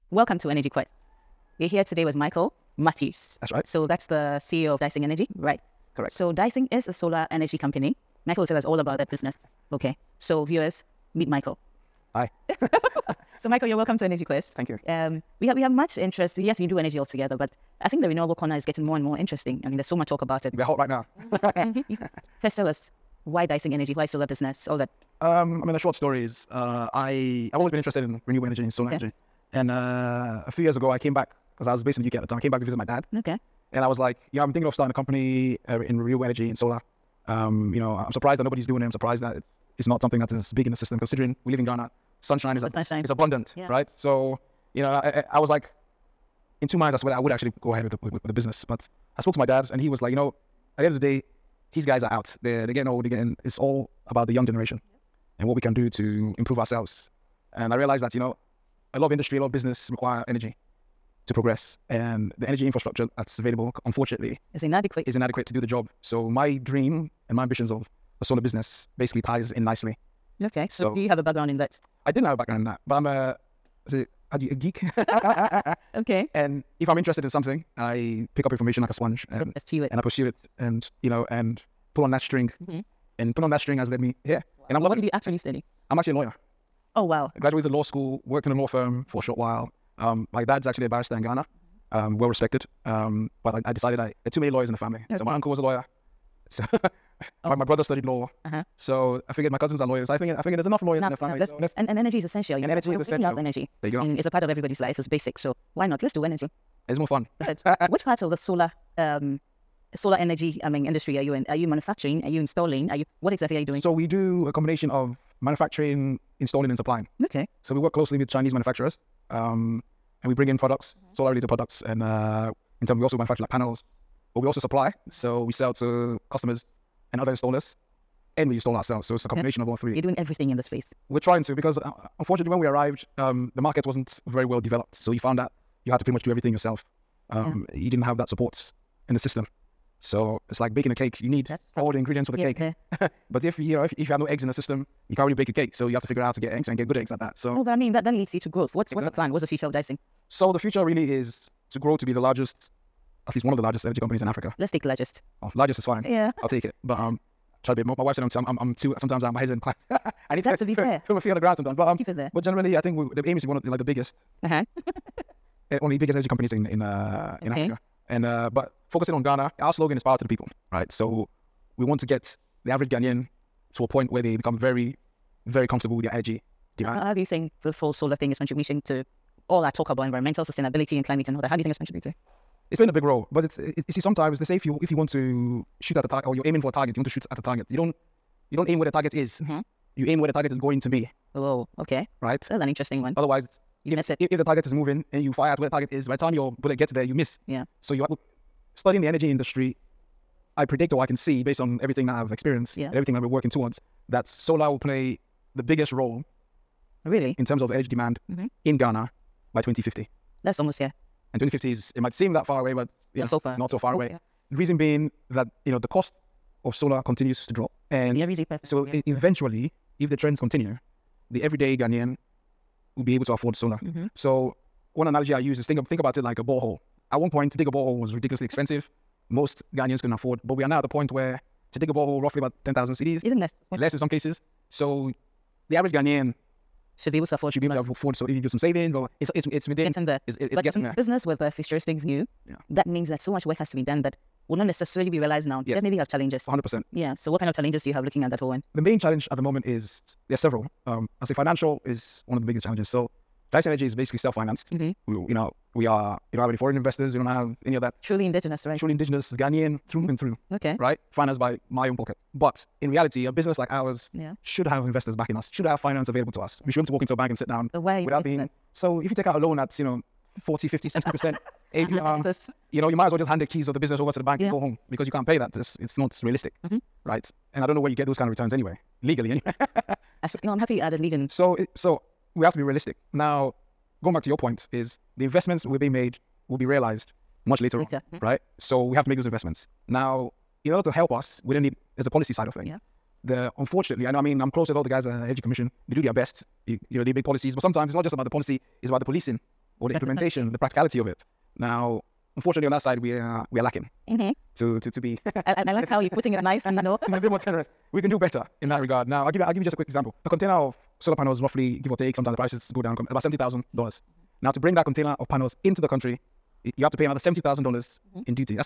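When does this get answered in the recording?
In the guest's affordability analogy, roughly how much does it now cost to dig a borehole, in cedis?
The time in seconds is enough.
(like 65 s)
232 s.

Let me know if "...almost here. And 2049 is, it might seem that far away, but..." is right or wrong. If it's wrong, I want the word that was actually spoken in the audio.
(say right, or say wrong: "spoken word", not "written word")
wrong: "2050", not "2049".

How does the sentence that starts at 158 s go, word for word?
Sometimes I'm, uh, my head's in class.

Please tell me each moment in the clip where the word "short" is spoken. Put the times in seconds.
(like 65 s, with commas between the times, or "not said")
25 s, 89 s.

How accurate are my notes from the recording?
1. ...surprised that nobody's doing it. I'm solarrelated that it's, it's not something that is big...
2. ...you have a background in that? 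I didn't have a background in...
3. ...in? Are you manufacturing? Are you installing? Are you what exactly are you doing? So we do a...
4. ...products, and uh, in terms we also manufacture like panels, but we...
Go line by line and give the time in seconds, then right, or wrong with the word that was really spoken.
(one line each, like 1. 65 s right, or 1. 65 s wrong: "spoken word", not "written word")
1. 38 s wrong: "surprised", not "solarrelated"
2. 70 s right
3. 111 s right
4. 121 s right.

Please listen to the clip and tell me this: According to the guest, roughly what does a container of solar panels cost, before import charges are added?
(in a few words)
$70,000.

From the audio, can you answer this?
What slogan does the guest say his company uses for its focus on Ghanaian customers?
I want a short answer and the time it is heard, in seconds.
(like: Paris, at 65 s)
Power to the people, at 170 s.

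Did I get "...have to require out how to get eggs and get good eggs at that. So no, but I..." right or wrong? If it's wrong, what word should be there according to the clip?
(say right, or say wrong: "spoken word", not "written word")
wrong: "figure", not "require".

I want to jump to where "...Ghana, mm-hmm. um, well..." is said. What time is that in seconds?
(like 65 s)
91 s.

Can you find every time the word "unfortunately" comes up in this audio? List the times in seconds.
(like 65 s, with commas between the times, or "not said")
63 s, 132 s, 293 s, 302 s.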